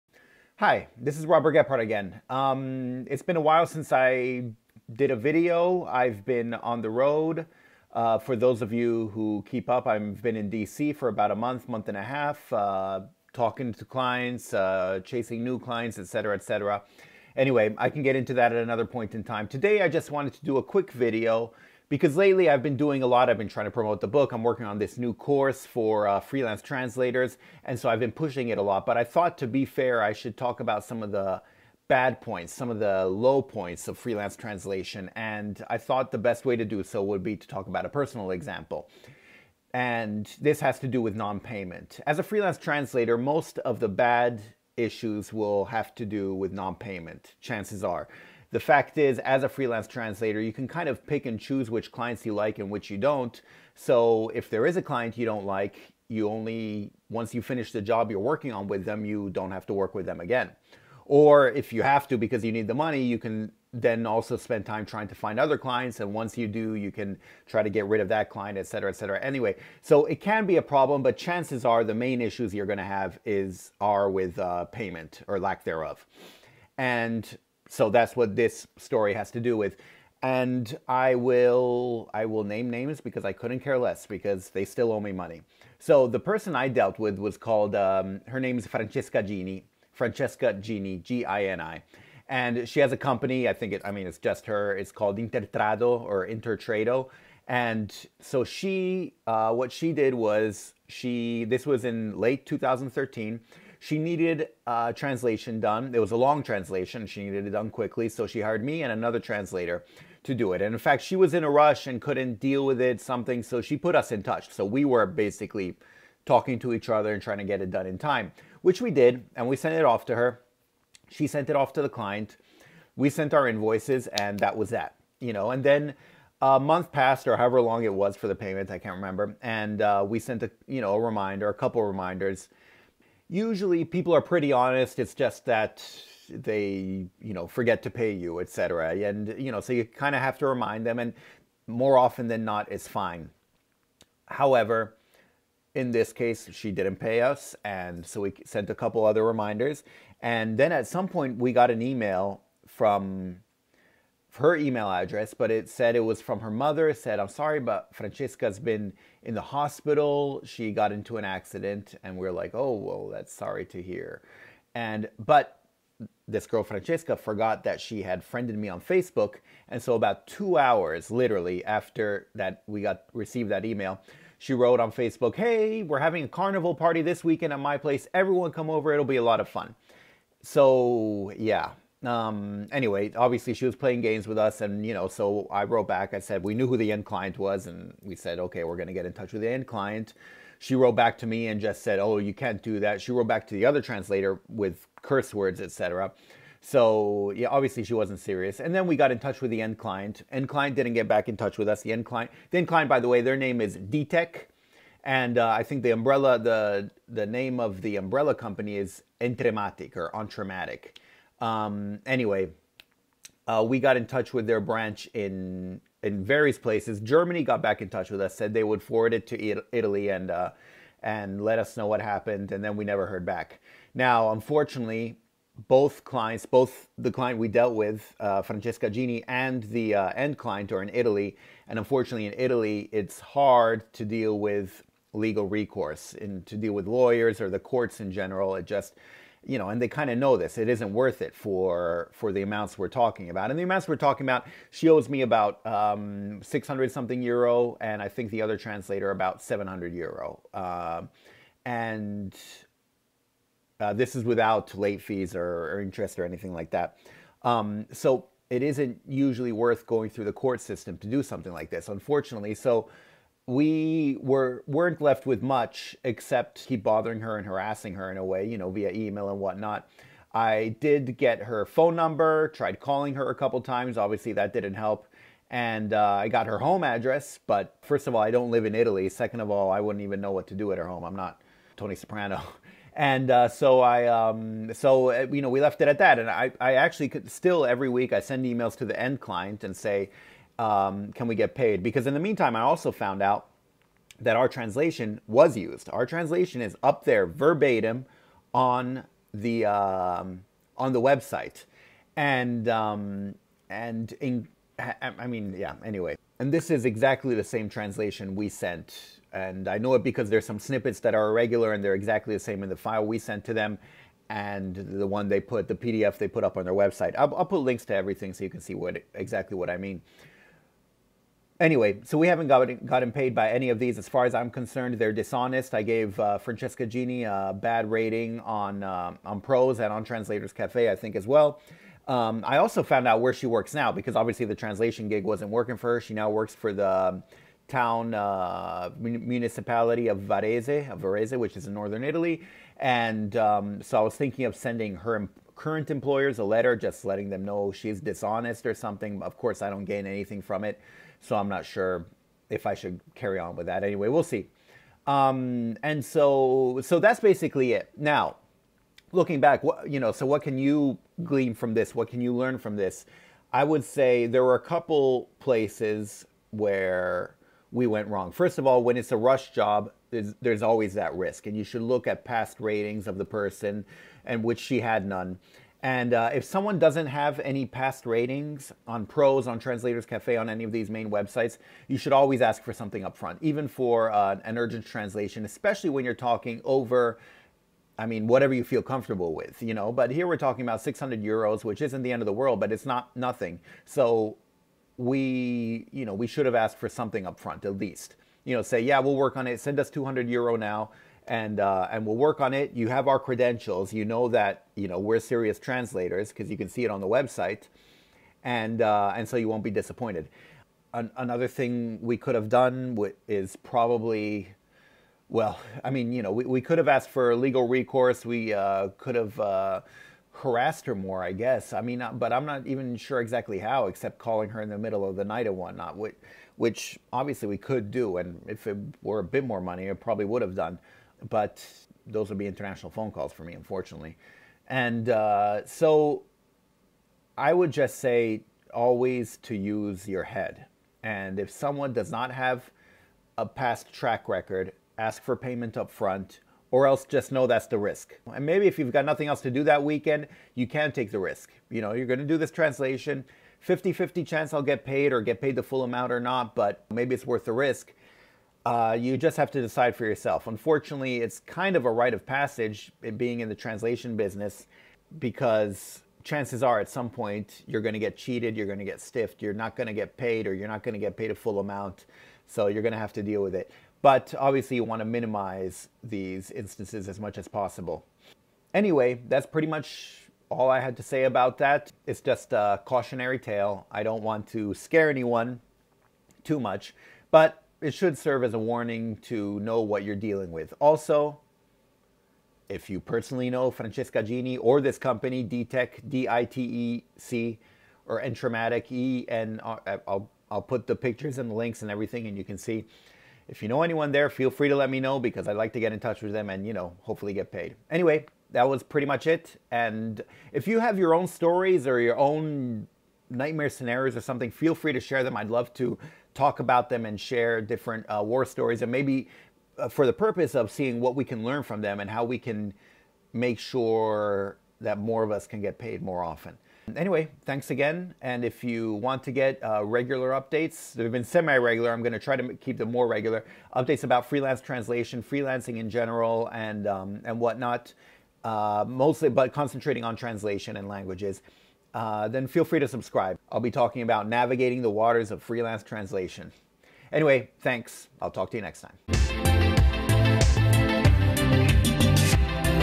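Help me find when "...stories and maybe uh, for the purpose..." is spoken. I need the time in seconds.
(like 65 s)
518 s.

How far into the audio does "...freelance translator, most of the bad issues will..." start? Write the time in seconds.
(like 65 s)
42 s.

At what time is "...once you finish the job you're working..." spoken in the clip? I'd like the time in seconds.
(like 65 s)
57 s.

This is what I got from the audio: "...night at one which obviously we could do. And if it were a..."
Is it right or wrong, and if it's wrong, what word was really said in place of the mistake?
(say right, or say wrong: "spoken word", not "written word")
right.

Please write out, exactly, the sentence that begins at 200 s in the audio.
End client didn't get back in touch with us.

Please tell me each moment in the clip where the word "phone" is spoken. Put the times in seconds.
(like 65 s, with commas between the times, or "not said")
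271 s, 432 s.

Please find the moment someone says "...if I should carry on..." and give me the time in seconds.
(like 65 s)
352 s.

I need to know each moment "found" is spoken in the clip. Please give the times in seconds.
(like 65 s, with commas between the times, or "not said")
292 s, 332 s.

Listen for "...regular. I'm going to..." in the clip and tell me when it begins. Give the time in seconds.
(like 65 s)
531 s.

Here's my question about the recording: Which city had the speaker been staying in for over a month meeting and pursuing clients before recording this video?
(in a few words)
DC.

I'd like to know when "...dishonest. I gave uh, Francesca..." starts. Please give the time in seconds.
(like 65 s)
325 s.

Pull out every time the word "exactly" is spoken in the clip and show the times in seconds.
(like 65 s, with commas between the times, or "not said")
306 s, 311 s, 319 s, 423 s.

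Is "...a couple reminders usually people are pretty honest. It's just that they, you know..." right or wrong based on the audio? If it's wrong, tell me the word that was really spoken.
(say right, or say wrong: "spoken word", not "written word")
right.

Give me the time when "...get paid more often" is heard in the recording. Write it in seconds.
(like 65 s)
525 s.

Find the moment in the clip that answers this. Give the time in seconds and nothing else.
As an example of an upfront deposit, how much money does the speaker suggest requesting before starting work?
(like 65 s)
399 s.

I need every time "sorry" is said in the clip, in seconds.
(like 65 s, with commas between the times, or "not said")
157 s, 163 s.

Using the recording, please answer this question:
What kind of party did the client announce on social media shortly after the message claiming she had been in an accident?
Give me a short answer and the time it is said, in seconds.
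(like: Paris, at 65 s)
Carnival party, at 176 s.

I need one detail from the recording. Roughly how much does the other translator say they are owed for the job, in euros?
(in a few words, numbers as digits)
700 euro.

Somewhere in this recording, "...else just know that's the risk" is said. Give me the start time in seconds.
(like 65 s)
446 s.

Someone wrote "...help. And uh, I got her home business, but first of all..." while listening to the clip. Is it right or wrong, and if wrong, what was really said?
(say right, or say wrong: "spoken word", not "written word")
wrong: "address", not "business".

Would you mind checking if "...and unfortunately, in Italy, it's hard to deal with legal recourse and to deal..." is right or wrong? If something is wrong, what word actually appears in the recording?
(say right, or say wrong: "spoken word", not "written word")
right.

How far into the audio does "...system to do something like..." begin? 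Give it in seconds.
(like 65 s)
260 s.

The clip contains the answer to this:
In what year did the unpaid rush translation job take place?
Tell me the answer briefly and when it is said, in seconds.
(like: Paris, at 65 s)
2013, at 102 s.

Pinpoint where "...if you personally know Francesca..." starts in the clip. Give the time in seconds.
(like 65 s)
492 s.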